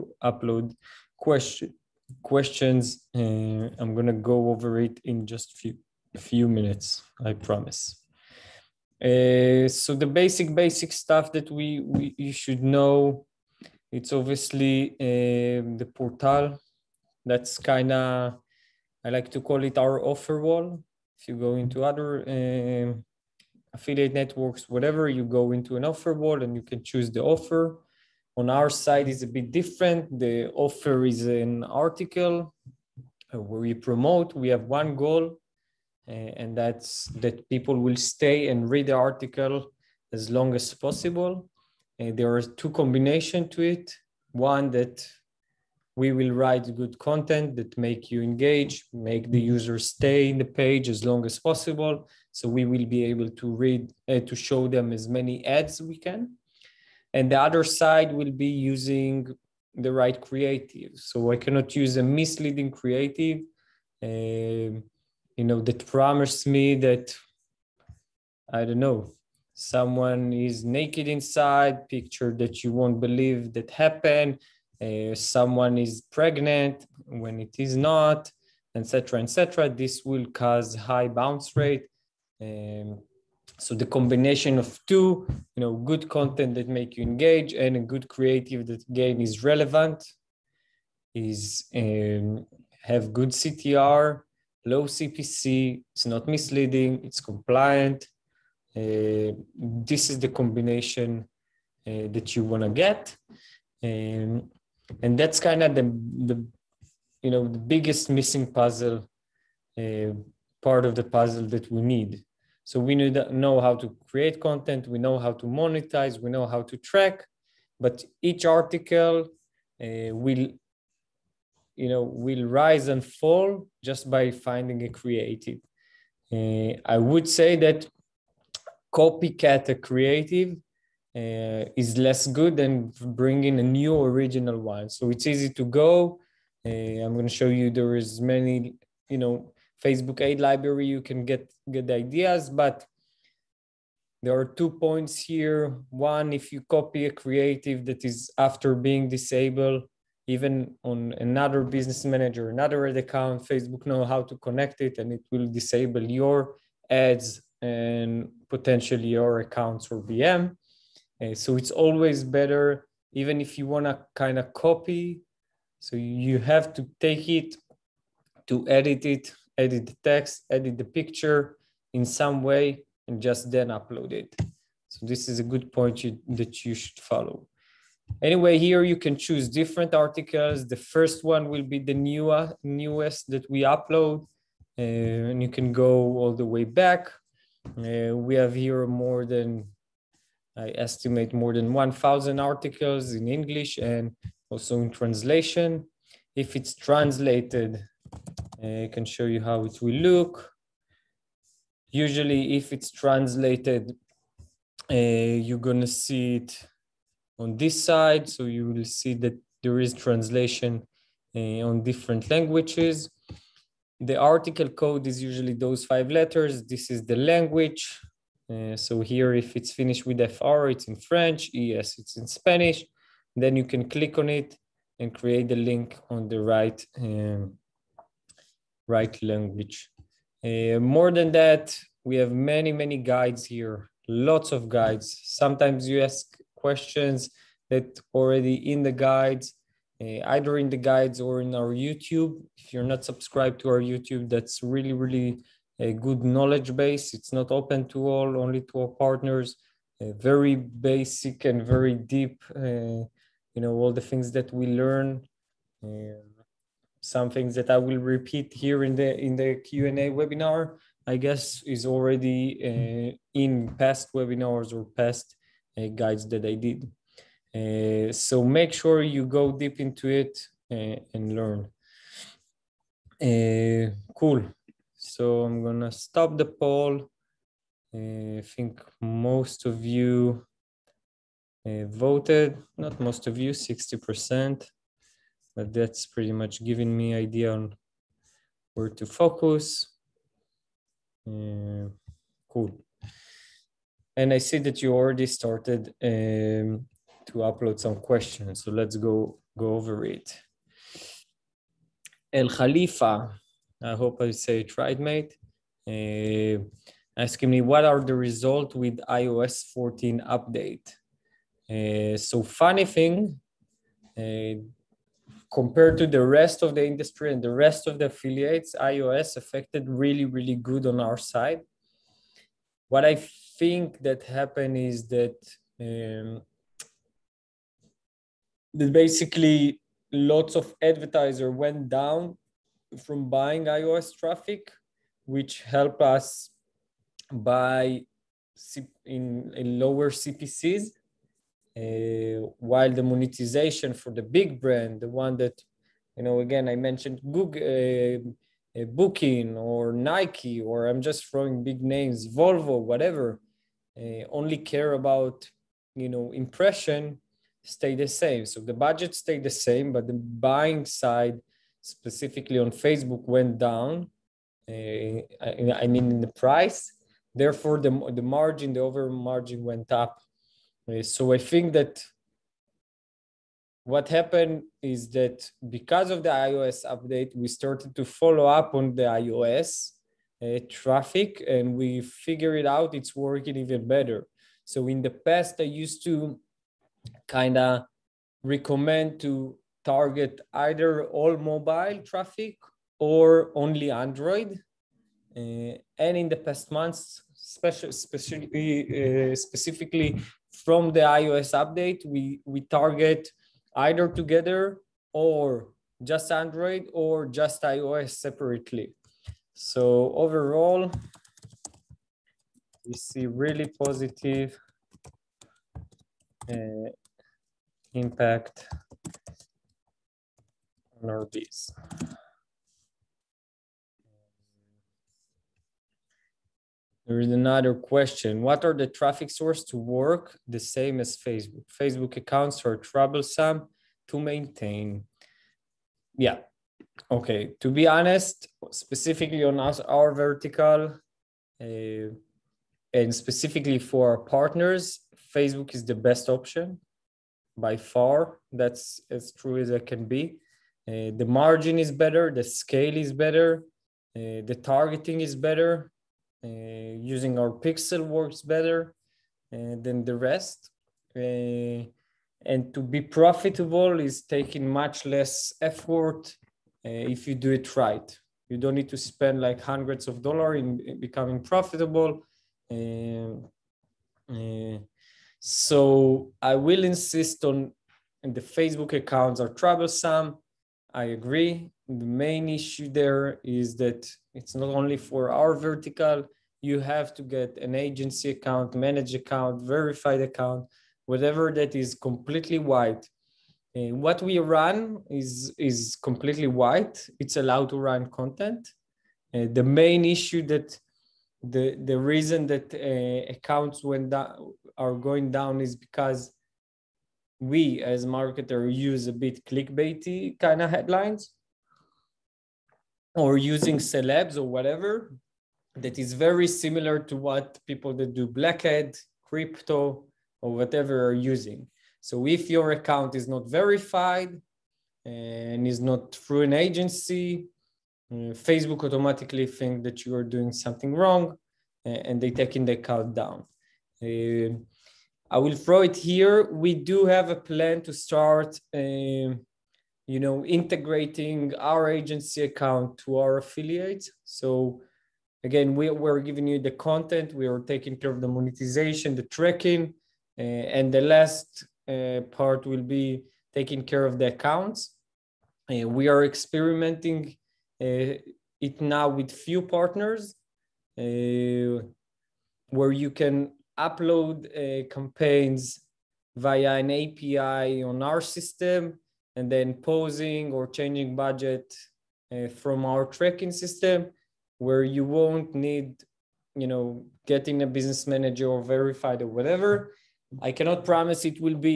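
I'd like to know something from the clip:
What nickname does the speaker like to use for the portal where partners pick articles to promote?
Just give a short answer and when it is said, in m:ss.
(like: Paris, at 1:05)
offer wall, at 0:20.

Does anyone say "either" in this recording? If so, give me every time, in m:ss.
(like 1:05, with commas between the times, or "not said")
4:00, 6:30, 6:43.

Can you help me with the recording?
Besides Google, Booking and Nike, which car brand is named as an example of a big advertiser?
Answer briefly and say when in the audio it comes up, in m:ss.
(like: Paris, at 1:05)
Volvo, at 5:52.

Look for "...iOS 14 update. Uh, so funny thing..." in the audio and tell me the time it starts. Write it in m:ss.
5:09.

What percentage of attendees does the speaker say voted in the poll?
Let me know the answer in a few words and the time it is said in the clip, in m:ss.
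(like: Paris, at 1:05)
60%, at 4:43.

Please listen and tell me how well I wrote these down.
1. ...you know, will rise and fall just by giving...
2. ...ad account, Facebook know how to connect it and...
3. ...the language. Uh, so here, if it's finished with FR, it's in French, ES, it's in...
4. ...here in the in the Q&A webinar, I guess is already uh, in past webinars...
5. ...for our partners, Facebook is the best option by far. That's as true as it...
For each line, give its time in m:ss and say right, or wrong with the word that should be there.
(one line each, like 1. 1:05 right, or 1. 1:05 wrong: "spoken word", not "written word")
1. 2:01 wrong: "finding", not "giving"
2. 2:32 right
3. 3:37 right
4. 4:18 right
5. 7:23 right.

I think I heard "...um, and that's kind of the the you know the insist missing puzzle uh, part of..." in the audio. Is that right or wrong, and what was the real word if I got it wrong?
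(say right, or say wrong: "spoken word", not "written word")
wrong: "biggest", not "insist".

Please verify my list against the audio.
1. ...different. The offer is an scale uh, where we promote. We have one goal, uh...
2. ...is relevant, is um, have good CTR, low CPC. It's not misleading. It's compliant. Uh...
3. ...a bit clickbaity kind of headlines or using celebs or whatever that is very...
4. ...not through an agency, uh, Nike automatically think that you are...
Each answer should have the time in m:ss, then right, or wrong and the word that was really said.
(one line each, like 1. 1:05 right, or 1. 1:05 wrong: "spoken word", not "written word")
1. 0:29 wrong: "article", not "scale"
2. 1:29 right
3. 8:29 right
4. 8:45 wrong: "Facebook", not "Nike".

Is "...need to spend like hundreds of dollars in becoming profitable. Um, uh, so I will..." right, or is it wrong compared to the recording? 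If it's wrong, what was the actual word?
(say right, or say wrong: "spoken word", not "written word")
right.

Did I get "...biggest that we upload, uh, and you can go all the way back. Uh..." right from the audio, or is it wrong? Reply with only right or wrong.
wrong.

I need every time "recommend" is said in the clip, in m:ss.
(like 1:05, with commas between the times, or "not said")
6:28.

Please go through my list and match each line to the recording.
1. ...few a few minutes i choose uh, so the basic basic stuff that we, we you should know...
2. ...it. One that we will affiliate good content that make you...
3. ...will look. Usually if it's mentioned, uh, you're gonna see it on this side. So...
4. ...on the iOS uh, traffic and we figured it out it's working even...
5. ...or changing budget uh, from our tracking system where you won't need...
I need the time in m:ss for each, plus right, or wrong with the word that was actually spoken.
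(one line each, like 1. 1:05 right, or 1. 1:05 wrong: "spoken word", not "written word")
1. 0:05 wrong: "promise", not "choose"
2. 0:43 wrong: "write", not "affiliate"
3. 3:19 wrong: "translated", not "mentioned"
4. 6:18 right
5. 9:30 right.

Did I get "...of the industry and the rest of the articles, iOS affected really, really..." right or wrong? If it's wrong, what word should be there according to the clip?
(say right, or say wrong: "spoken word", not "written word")
wrong: "affiliates", not "articles".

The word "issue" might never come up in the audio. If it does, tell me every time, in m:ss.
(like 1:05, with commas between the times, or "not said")
8:02, 8:20.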